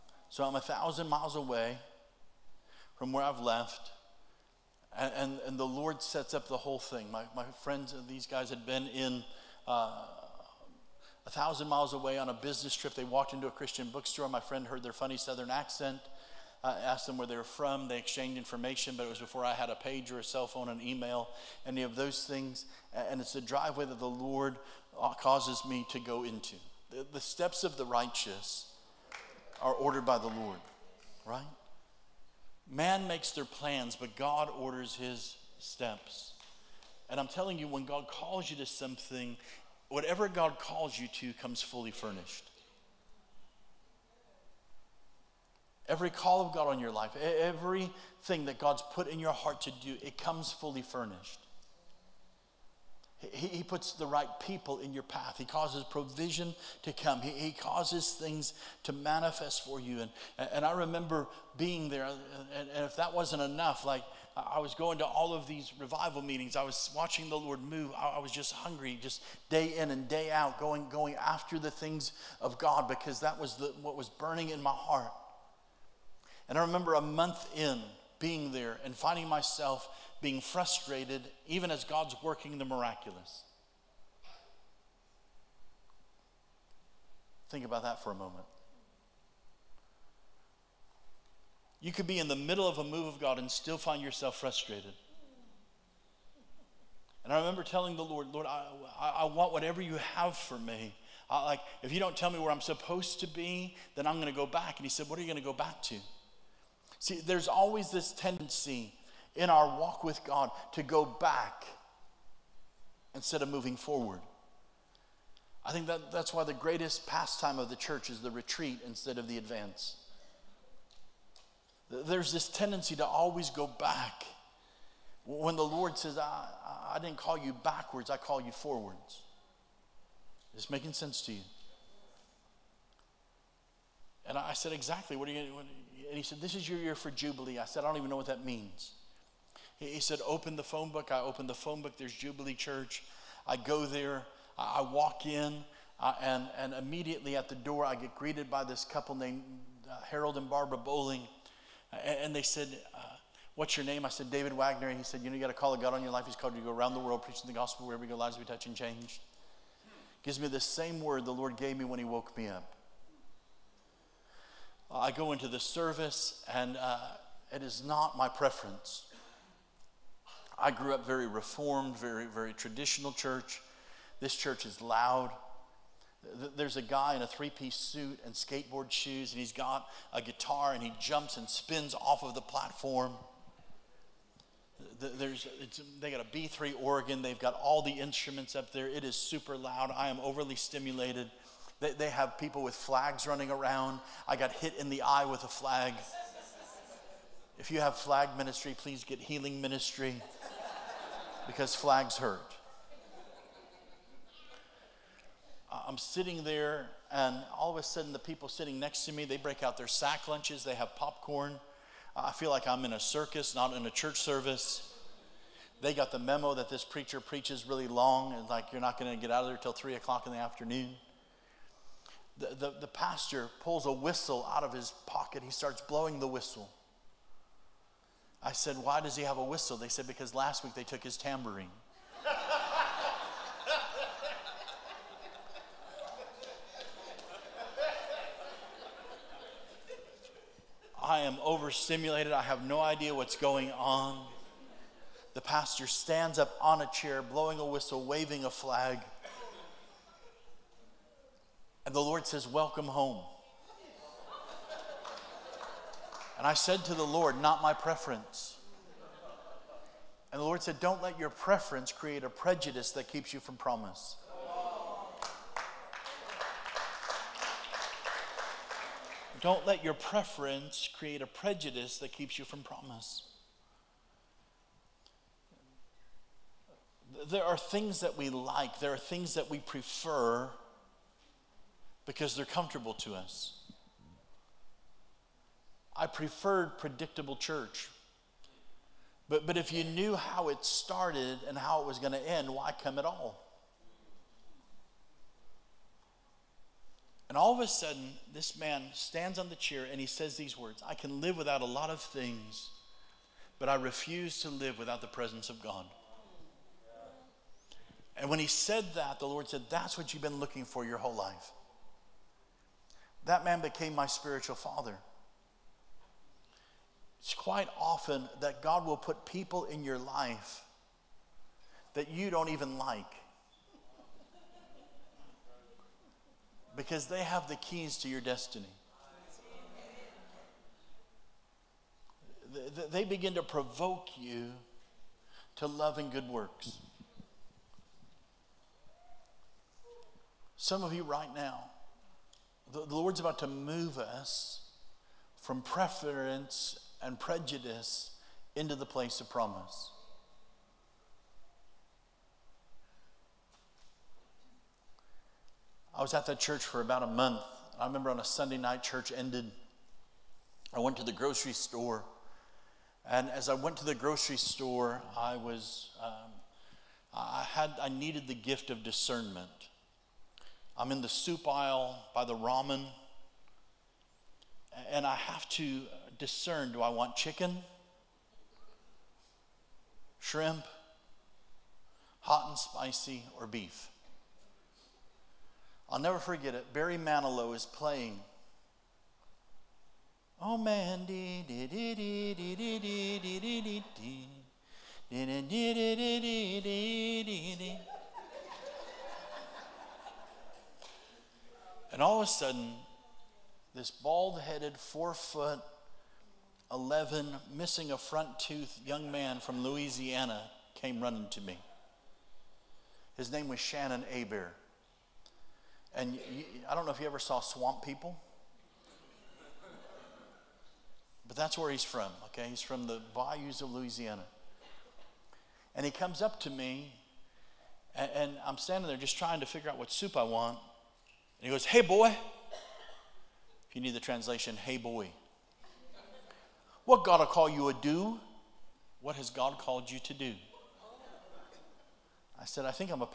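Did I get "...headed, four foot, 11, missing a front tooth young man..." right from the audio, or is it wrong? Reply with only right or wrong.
right.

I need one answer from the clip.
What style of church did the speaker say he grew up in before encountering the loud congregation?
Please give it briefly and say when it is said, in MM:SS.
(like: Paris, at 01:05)
Reformed, at 02:51.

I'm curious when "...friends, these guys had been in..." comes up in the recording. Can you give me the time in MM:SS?
00:07.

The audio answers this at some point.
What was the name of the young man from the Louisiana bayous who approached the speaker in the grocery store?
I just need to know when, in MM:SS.
06:53.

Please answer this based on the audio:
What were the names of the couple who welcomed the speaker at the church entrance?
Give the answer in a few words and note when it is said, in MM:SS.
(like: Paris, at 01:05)
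Harold and Barbara Bowling, at 02:30.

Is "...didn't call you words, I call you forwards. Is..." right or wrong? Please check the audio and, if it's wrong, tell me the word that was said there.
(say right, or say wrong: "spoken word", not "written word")
wrong: "backwards", not "words".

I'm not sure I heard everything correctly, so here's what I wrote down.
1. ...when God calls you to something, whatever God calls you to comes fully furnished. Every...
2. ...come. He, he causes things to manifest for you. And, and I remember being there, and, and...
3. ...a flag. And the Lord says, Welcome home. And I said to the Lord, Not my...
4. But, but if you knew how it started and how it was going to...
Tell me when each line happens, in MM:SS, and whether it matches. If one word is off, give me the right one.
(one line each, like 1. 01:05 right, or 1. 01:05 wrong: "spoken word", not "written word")
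1. 00:37 right
2. 00:56 right
3. 04:08 right
4. 04:49 right.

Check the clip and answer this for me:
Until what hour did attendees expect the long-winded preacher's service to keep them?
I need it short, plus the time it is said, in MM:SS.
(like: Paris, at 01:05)
3 o'clock, at 03:39.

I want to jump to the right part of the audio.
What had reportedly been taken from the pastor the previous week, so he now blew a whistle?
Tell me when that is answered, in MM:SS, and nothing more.
03:51.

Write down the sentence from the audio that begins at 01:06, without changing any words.
I was watching the Lord move.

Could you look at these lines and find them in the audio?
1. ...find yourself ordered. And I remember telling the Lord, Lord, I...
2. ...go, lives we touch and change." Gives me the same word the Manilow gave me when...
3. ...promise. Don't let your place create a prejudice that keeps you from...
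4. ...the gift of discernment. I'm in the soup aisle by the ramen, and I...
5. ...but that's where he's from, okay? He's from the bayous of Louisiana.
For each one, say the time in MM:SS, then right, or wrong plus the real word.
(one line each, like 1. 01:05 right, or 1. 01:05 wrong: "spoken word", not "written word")
1. 01:33 wrong: "frustrated", not "ordered"
2. 02:38 wrong: "Lord", not "Manilow"
3. 04:23 wrong: "preference", not "place"
4. 06:08 right
5. 07:01 right.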